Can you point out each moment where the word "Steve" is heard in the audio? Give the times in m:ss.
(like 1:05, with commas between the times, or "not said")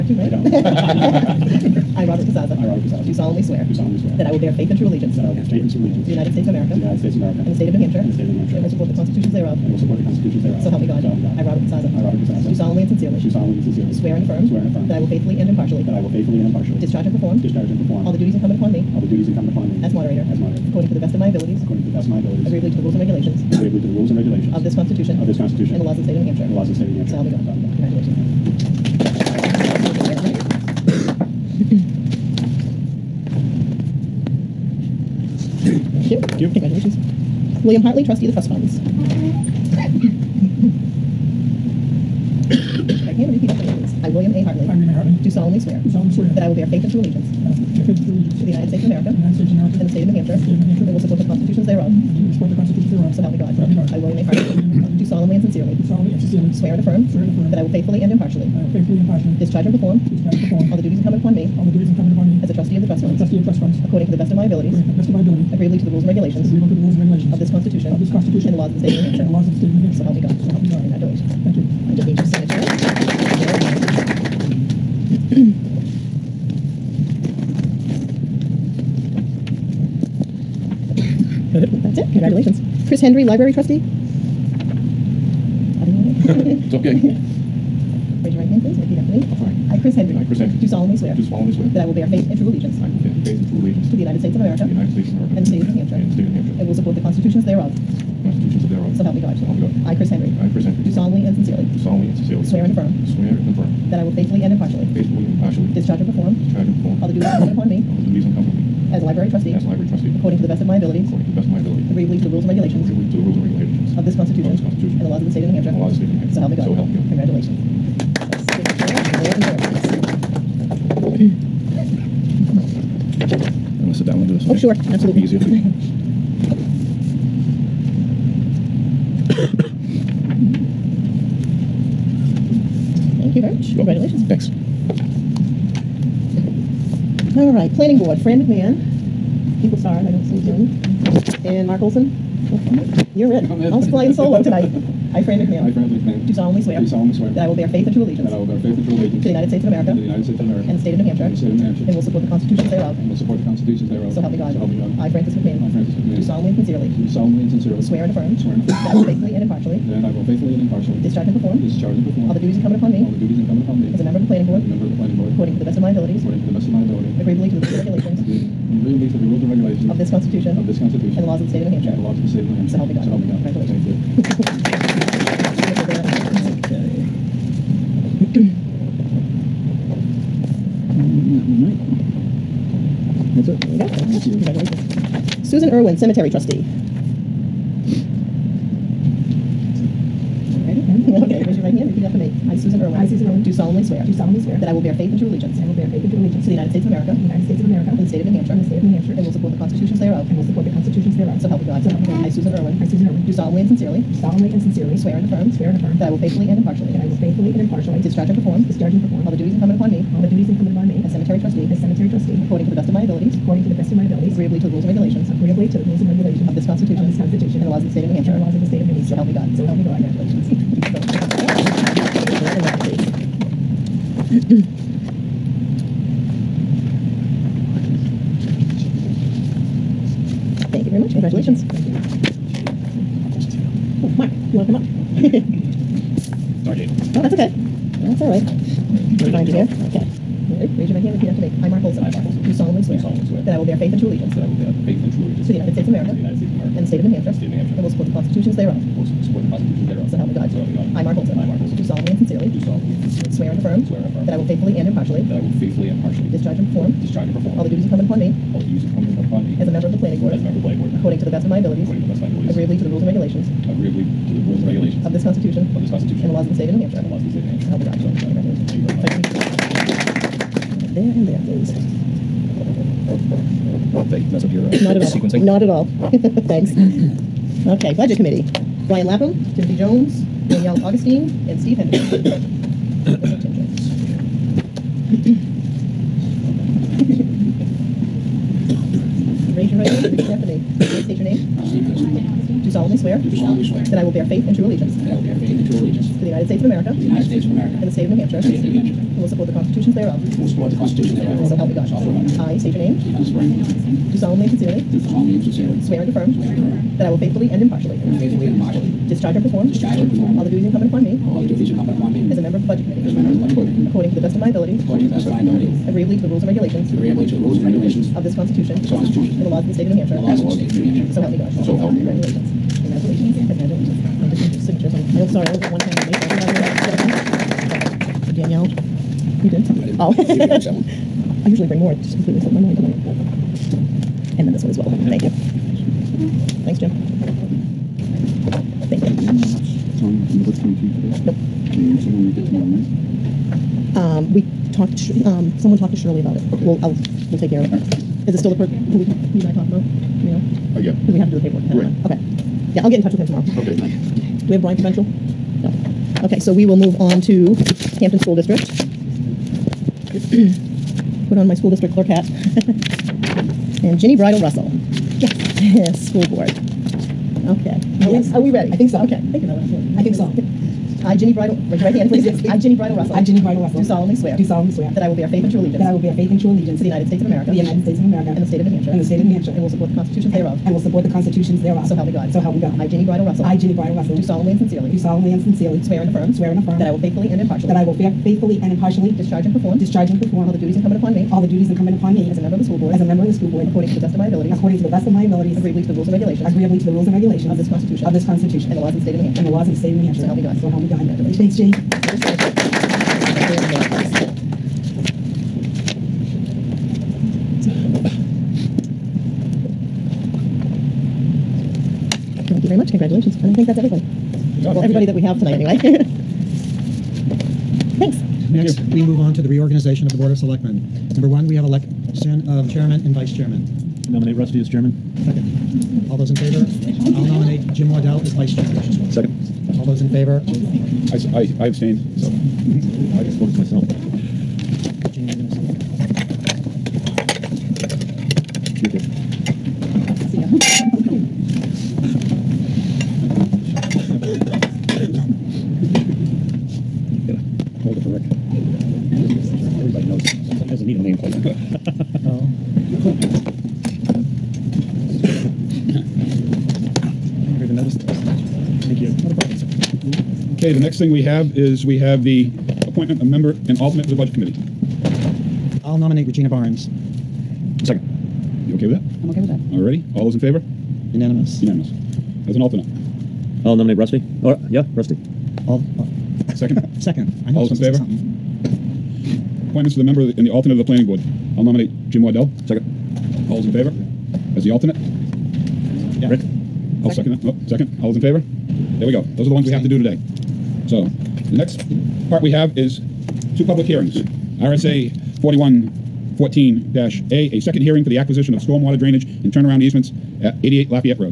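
4:41, 4:51, 5:02.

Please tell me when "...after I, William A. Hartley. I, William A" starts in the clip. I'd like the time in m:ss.
0:43.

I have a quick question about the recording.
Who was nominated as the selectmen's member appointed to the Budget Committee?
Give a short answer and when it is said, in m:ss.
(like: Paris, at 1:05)
Regina Barnes, at 7:46.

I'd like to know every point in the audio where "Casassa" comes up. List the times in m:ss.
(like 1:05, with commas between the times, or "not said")
0:02, 0:11.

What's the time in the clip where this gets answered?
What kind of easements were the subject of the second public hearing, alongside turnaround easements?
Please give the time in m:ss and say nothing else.
8:18.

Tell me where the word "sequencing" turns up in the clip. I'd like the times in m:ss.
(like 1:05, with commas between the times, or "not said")
4:35.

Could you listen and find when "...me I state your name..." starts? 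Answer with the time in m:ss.
5:02.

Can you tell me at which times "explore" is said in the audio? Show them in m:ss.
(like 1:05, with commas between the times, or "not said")
not said.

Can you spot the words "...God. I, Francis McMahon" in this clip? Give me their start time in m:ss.
2:34.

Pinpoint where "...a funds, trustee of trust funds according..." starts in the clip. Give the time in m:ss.
1:03.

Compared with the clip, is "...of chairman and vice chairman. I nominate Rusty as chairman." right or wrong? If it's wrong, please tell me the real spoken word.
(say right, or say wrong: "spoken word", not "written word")
right.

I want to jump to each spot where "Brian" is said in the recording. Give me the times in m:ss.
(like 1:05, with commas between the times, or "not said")
4:38, 5:54.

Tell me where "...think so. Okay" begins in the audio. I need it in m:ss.
6:08.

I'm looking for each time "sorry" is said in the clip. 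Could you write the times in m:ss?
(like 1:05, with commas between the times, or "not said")
3:56, 5:25.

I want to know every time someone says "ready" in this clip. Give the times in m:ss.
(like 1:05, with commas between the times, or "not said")
4:00, 6:08.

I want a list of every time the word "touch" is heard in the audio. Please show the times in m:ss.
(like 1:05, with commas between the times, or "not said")
5:53.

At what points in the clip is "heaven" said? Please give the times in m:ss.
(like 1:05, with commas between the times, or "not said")
not said.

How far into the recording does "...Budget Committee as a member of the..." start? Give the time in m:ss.
5:12.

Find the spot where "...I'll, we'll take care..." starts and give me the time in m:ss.
5:46.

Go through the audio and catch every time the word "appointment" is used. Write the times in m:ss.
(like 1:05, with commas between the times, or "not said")
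7:42, 7:59.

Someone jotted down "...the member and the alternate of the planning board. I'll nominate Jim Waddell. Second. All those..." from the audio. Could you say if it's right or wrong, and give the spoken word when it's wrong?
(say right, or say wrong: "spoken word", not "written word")
right.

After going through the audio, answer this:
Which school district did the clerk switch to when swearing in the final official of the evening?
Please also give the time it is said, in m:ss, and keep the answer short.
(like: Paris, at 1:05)
Hampton School District, at 5:58.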